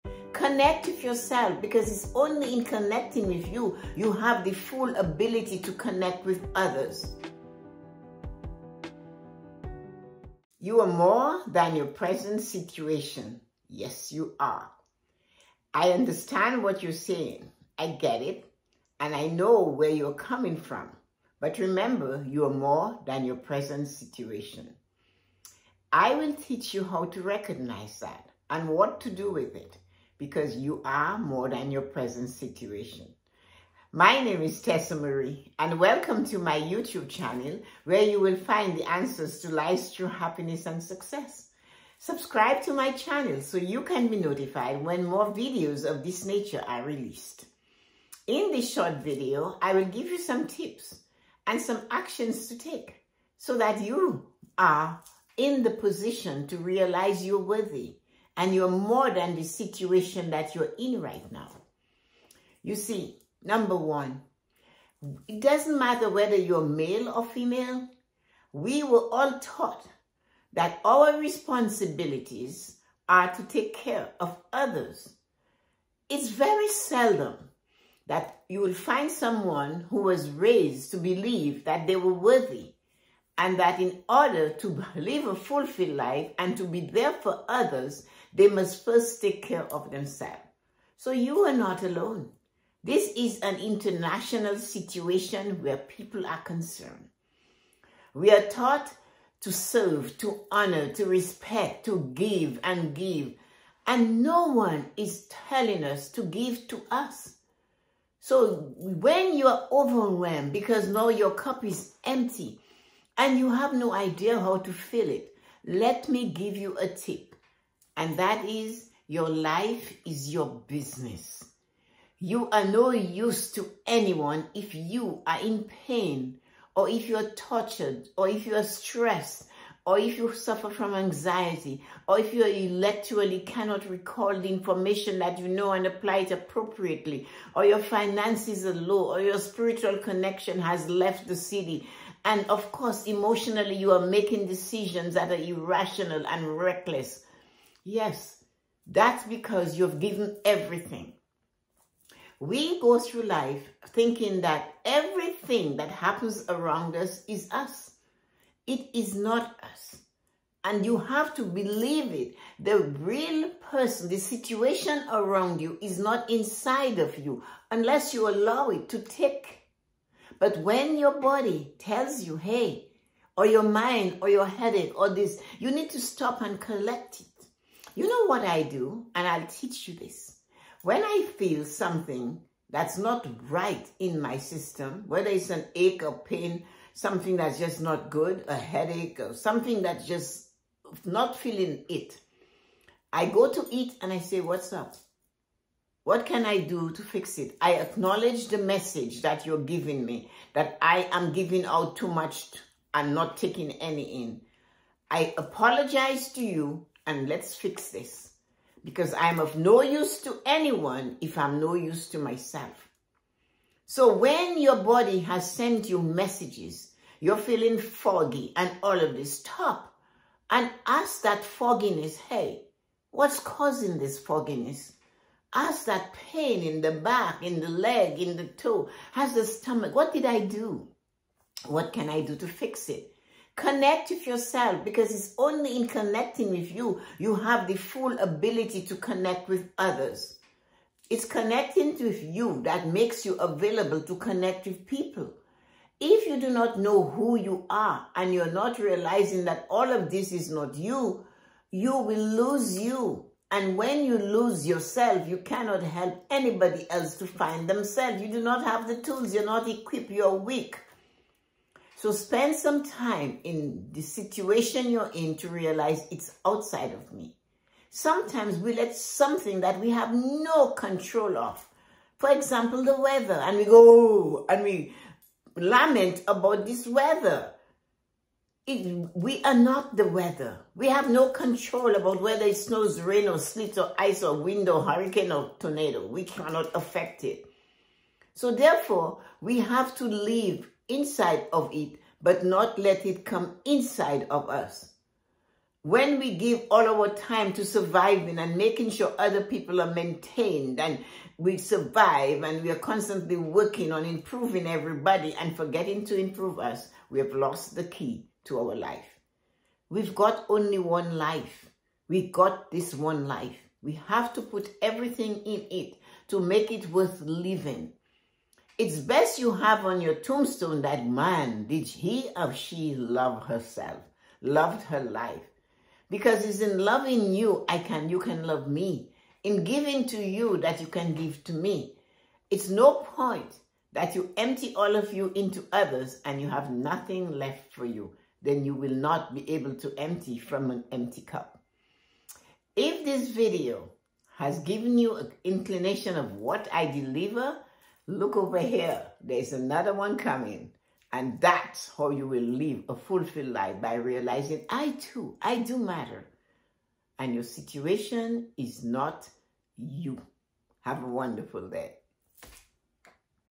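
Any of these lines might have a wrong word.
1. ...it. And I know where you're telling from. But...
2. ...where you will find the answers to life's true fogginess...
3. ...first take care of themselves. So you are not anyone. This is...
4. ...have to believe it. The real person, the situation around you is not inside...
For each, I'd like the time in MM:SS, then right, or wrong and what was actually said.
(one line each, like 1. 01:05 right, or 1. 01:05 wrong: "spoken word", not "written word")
1. 00:18 wrong: "coming", not "telling"
2. 00:37 wrong: "happiness", not "fogginess"
3. 01:28 wrong: "alone", not "anyone"
4. 02:40 right.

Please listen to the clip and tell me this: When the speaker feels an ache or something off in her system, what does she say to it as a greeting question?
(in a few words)
What's up?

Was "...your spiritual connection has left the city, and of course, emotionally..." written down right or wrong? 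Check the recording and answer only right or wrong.
right.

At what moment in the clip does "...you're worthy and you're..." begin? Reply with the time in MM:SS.
00:57.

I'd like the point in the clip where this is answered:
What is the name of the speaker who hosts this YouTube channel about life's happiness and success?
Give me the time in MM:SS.
00:34.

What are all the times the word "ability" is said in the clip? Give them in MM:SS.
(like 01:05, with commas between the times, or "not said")
00:04, 03:58.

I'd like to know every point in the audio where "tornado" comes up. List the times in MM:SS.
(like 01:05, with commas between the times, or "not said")
04:45.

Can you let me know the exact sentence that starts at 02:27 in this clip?
Yes, that's because you've given everything.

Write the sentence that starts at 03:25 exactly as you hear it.
I apologize to you and let's fix this because I'm of no use to anyone if I'm no use to myself.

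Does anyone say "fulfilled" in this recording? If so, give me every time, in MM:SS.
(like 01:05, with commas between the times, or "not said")
01:25, 05:52.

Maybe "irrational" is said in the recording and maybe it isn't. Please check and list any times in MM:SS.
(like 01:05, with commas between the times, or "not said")
02:25.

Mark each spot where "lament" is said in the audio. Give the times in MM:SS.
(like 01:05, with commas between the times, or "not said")
04:35.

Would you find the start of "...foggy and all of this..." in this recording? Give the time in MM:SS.
03:37.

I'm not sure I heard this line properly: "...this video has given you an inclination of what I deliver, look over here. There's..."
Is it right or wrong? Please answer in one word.
right.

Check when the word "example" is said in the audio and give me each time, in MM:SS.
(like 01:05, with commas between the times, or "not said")
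04:32.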